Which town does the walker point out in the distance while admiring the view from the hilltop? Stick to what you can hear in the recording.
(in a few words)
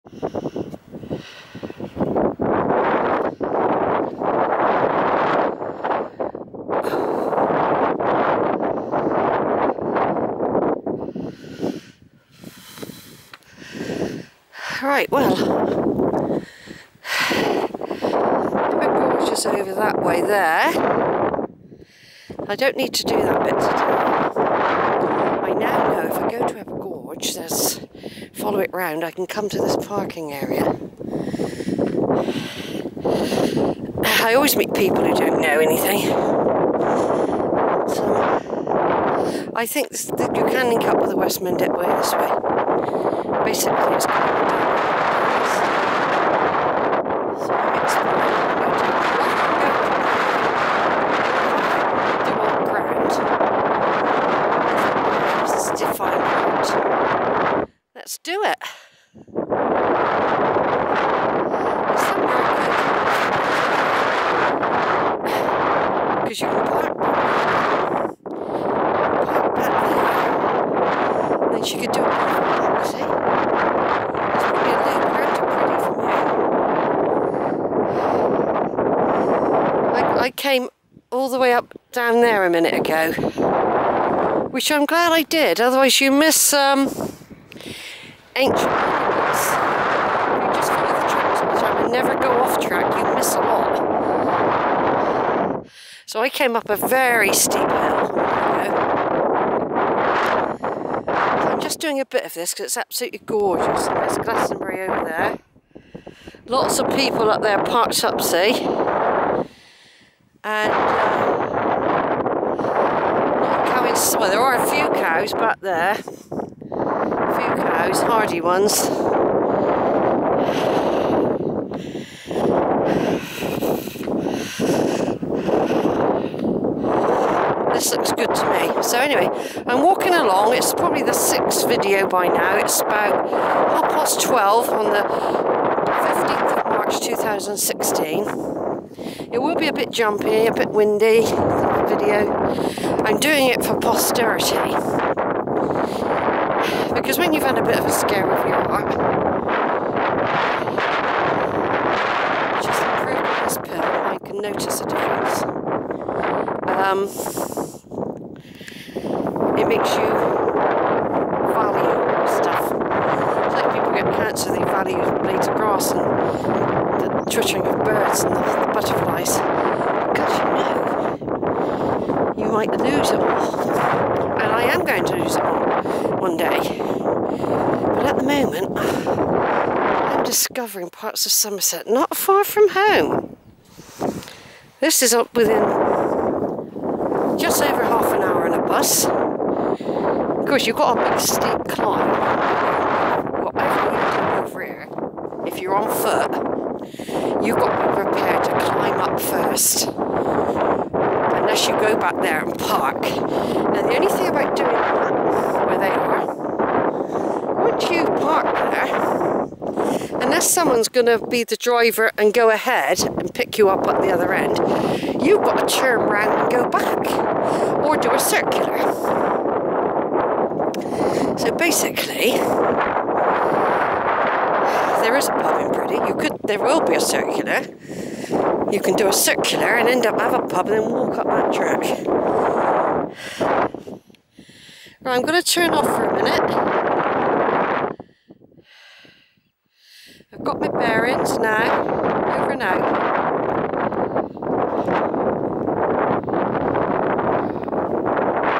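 Glastonbury.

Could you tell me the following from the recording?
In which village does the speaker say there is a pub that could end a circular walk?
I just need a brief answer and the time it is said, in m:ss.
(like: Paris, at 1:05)
Priddy, at 3:45.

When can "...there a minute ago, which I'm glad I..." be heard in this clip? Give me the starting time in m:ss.
1:22.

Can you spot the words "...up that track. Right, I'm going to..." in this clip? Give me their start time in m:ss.
3:51.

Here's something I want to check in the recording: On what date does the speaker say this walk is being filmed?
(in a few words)
15 March 2016.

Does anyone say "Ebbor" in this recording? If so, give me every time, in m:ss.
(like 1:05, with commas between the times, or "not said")
0:26.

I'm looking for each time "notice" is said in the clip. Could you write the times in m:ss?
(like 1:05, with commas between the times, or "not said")
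2:34.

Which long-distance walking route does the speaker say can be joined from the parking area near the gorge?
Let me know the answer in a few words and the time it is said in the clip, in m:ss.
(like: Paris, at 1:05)
West Mendip Way, at 0:41.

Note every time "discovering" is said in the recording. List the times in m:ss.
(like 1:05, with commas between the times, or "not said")
3:00.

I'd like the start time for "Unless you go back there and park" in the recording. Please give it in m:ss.
3:19.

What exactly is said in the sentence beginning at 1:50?
and uh, there are a few cows back there, a few cows, hardy ones.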